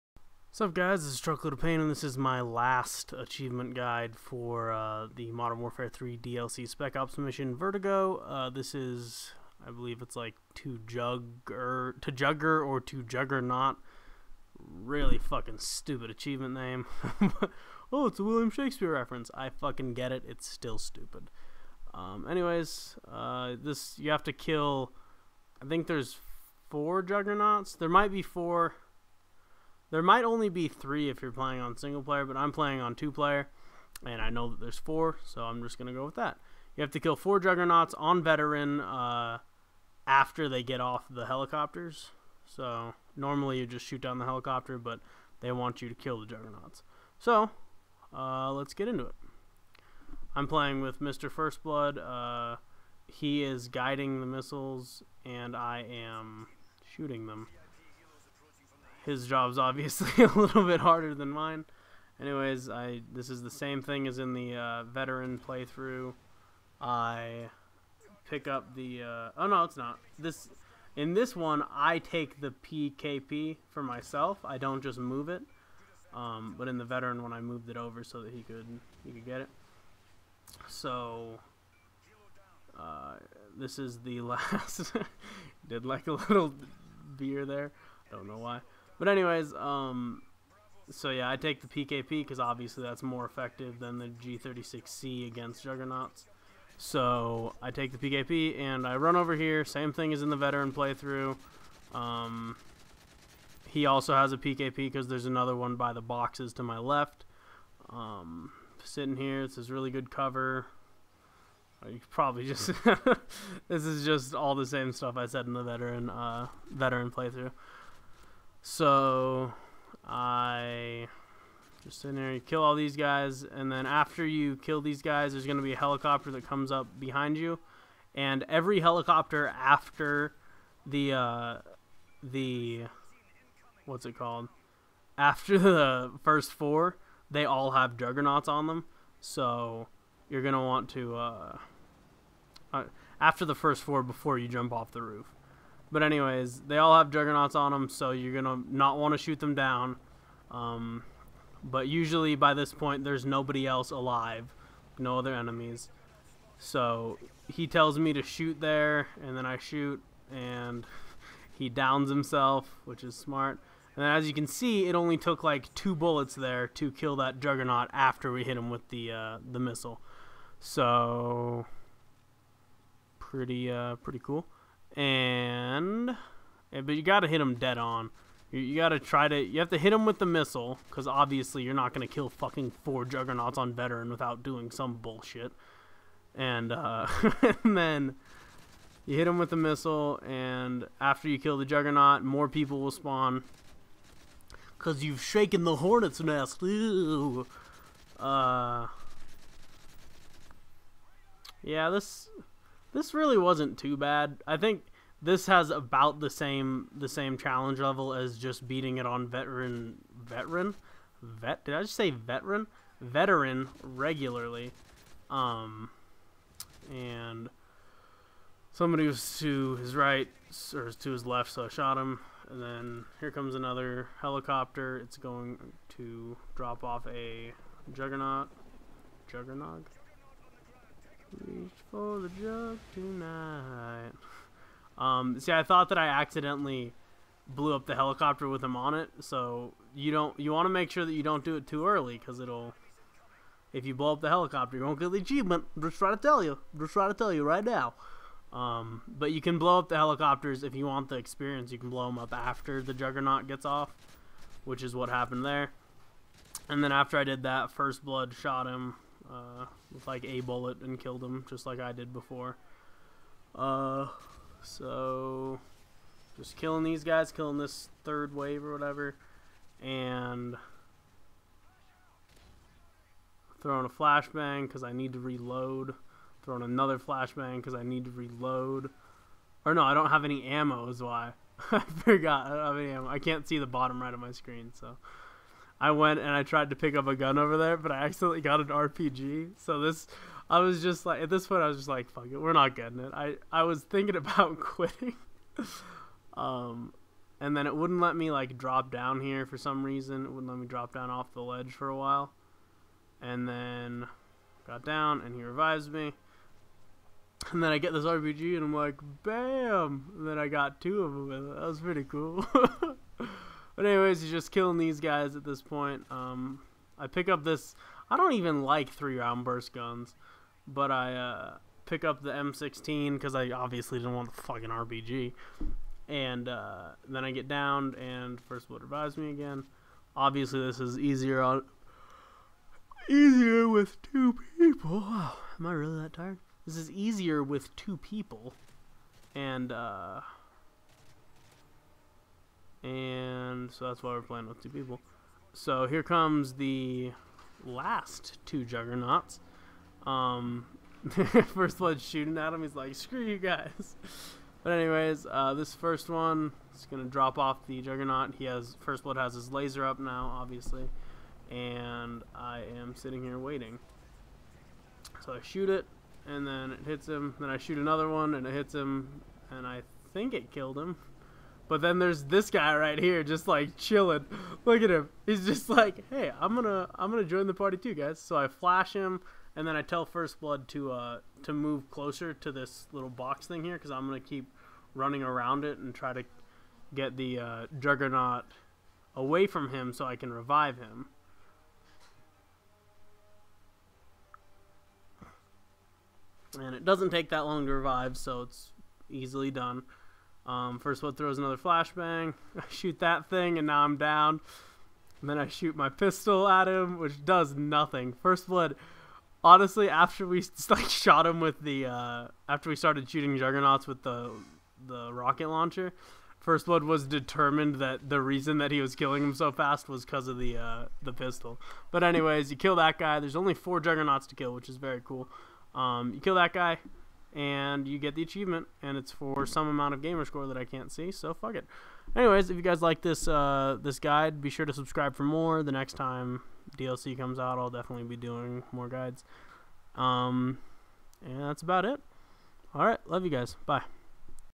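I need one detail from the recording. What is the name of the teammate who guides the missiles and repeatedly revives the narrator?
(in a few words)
Mr. First Blood.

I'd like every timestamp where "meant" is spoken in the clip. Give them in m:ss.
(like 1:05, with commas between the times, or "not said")
not said.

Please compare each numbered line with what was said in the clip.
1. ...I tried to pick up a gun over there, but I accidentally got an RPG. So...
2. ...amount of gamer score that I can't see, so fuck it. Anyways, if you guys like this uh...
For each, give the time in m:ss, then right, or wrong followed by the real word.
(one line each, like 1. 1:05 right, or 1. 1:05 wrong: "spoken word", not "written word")
1. 4:46 right
2. 7:09 right.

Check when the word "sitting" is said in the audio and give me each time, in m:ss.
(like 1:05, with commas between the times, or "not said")
1:48, 6:02.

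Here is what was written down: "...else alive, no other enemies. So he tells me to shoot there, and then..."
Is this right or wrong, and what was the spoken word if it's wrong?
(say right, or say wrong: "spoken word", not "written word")
right.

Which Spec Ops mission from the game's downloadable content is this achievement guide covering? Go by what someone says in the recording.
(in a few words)
Vertigo.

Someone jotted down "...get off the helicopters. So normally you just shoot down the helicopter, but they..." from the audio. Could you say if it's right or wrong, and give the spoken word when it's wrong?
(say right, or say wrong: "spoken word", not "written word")
right.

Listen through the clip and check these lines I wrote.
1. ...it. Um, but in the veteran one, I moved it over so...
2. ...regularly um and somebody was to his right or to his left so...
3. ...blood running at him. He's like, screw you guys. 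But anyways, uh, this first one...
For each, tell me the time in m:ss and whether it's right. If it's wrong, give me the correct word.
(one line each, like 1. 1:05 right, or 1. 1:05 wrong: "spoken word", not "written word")
1. 1:15 right
2. 3:33 right
3. 5:51 wrong: "shooting", not "running".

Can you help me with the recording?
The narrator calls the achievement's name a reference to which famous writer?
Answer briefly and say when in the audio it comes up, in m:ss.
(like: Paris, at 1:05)
William Shakespeare, at 0:18.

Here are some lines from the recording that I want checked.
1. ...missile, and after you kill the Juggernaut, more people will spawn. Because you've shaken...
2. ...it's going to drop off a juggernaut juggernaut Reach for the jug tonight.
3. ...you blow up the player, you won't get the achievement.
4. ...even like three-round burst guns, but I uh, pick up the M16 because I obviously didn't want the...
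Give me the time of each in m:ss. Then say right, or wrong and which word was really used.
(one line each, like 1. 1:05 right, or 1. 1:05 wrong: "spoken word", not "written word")
1. 3:09 right
2. 3:44 right
3. 4:03 wrong: "helicopter", not "player"
4. 5:18 right.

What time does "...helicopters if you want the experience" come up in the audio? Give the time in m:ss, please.
4:09.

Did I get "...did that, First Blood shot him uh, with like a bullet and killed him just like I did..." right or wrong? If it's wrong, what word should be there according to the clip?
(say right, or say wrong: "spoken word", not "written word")
right.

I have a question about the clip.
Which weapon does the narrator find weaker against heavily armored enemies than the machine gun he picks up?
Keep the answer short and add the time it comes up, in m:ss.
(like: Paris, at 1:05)
G36C, at 1:34.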